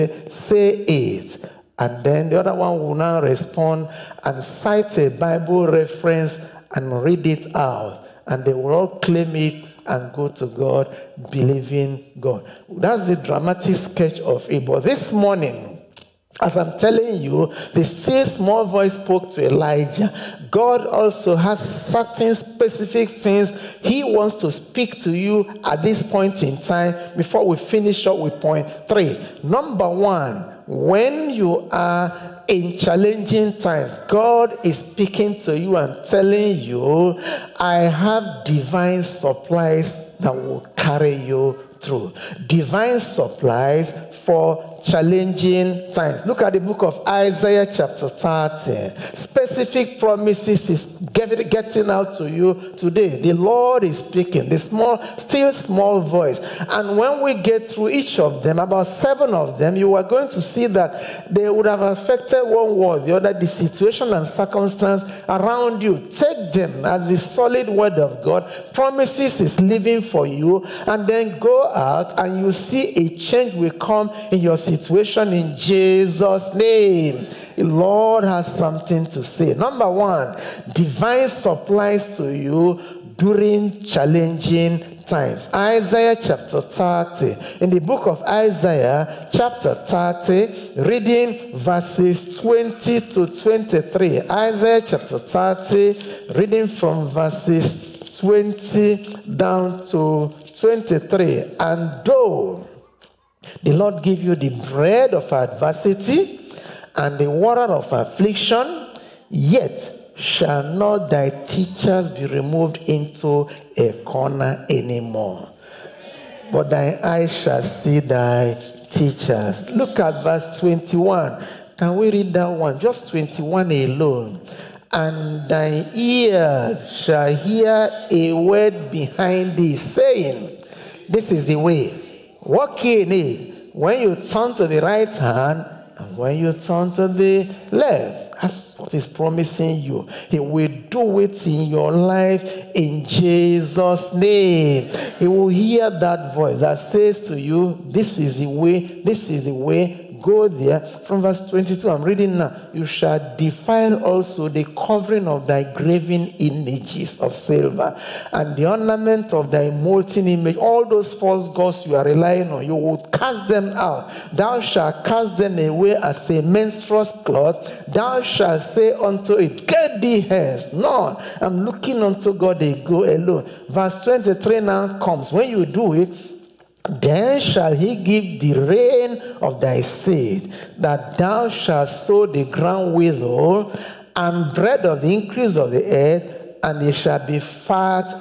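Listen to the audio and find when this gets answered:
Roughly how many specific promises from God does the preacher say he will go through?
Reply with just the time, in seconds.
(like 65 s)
58 s.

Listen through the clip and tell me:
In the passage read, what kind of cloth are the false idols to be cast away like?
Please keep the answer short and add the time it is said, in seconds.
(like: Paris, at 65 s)
menstruous cloth, at 166 s.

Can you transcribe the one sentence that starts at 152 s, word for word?
You shall defile also the covering of thy graven images of silver and the ornament of thy molten image.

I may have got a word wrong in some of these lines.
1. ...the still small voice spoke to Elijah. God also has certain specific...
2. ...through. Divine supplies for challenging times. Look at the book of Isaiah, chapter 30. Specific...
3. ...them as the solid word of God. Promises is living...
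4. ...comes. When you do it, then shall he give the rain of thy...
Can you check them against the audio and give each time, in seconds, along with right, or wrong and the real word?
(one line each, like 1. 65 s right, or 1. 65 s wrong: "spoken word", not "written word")
1. 17 s right
2. 41 s right
3. 66 s right
4. 174 s right.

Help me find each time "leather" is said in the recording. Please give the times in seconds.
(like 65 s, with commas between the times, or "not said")
not said.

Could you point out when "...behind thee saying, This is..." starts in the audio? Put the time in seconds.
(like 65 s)
128 s.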